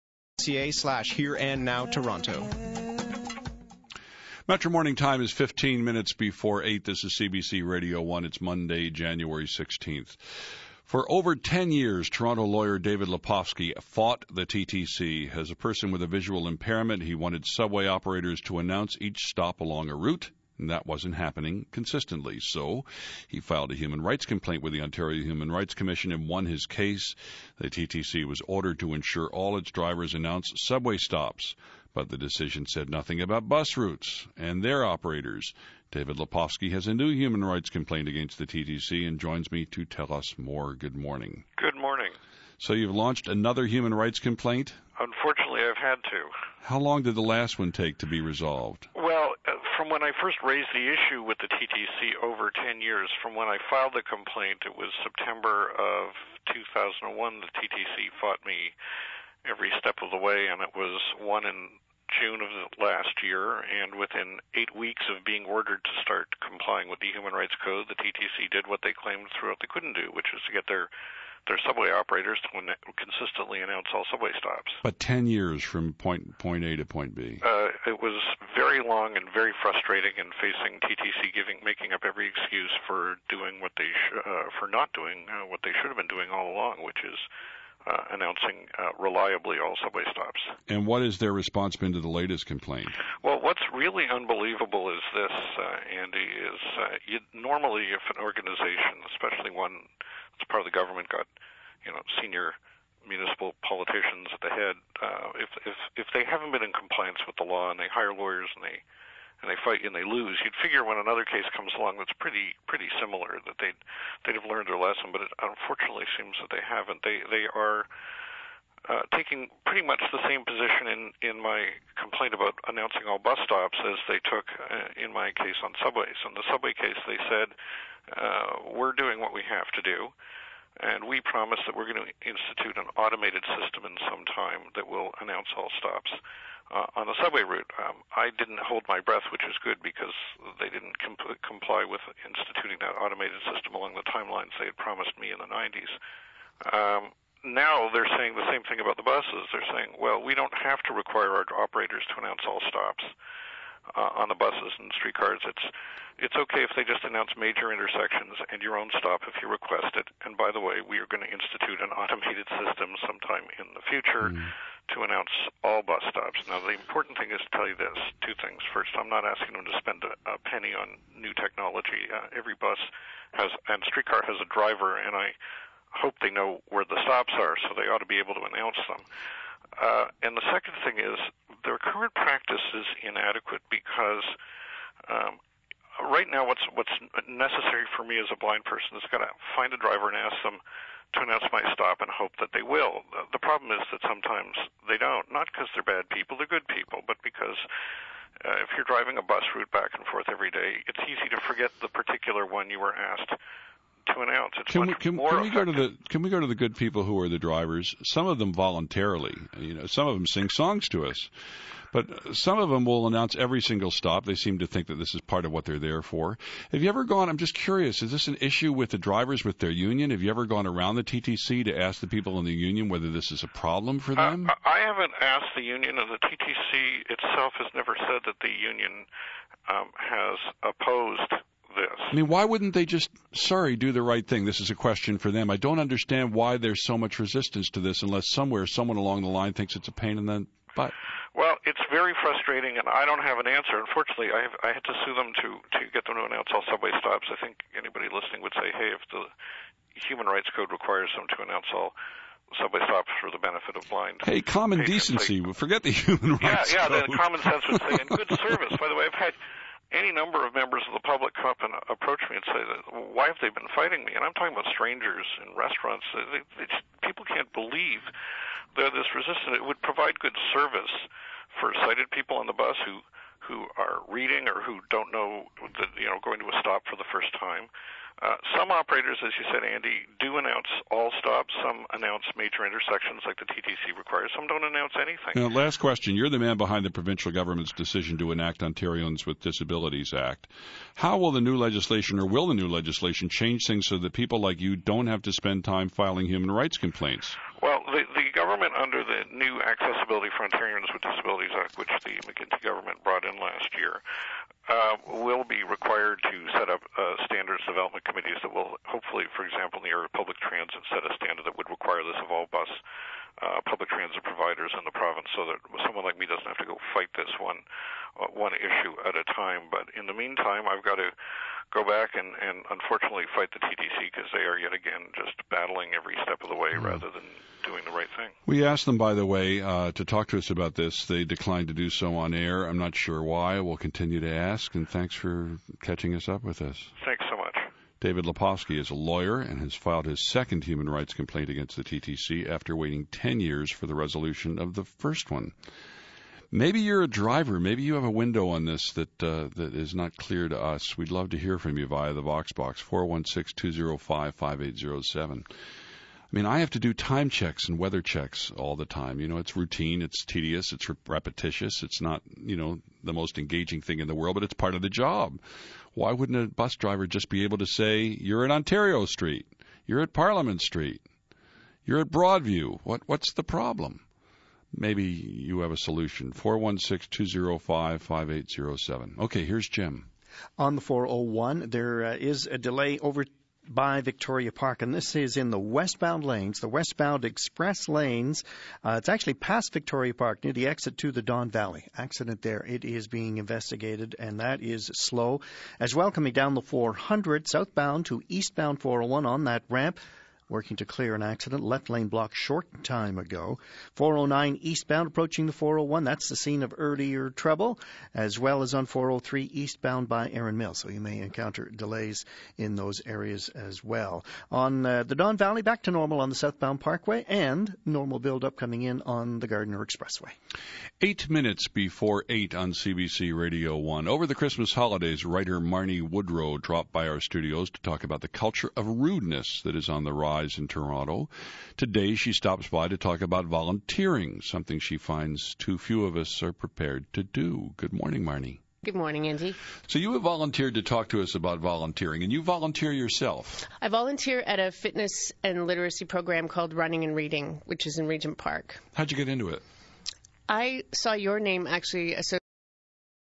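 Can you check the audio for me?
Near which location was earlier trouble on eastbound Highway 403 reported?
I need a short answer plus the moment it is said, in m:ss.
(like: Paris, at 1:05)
Erin Mill, at 6:50.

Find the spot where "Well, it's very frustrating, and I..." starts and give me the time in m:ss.
4:01.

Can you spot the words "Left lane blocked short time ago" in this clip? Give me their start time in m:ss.
6:41.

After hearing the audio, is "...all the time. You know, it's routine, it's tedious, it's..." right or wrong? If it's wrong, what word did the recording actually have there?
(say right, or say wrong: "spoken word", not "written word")
right.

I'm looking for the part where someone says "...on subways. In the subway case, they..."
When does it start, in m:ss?
2:05.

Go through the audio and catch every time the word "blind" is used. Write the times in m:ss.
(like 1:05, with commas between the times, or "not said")
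3:08, 4:13.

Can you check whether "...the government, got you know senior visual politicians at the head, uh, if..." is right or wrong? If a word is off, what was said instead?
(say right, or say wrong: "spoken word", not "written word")
wrong: "municipal", not "visual".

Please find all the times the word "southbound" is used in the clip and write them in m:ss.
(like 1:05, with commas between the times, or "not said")
6:37, 6:56.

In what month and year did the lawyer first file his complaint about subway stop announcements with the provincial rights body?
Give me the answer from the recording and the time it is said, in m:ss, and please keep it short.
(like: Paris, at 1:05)
September 2001, at 0:55.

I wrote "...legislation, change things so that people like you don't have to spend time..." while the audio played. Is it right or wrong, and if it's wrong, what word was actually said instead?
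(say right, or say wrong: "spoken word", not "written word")
right.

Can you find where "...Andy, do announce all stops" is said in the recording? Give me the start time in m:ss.
4:39.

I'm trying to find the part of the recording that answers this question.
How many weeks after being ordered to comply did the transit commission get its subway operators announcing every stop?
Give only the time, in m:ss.
1:04.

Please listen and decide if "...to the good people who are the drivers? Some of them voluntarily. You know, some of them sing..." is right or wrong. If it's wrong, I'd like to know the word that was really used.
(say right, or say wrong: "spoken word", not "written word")
right.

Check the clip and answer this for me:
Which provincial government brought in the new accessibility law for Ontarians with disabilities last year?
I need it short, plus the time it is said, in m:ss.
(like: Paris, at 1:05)
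McGuinty government, at 5:02.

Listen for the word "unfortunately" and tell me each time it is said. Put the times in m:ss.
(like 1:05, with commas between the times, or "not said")
0:44, 1:55, 4:03, 5:22.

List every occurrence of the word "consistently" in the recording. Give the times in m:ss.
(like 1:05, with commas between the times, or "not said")
0:21, 1:12.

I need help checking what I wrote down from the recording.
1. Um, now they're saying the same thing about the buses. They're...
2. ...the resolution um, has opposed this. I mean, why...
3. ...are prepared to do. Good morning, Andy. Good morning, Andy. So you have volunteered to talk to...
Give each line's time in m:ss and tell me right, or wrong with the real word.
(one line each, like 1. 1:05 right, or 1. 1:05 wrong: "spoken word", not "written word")
1. 2:26 right
2. 3:48 wrong: "union", not "resolution"
3. 7:16 wrong: "Marnie", not "Andy".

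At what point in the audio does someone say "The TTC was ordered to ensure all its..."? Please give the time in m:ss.
0:27.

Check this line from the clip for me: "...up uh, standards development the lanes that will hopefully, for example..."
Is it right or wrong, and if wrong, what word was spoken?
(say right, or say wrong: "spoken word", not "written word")
wrong: "committees", not "lanes".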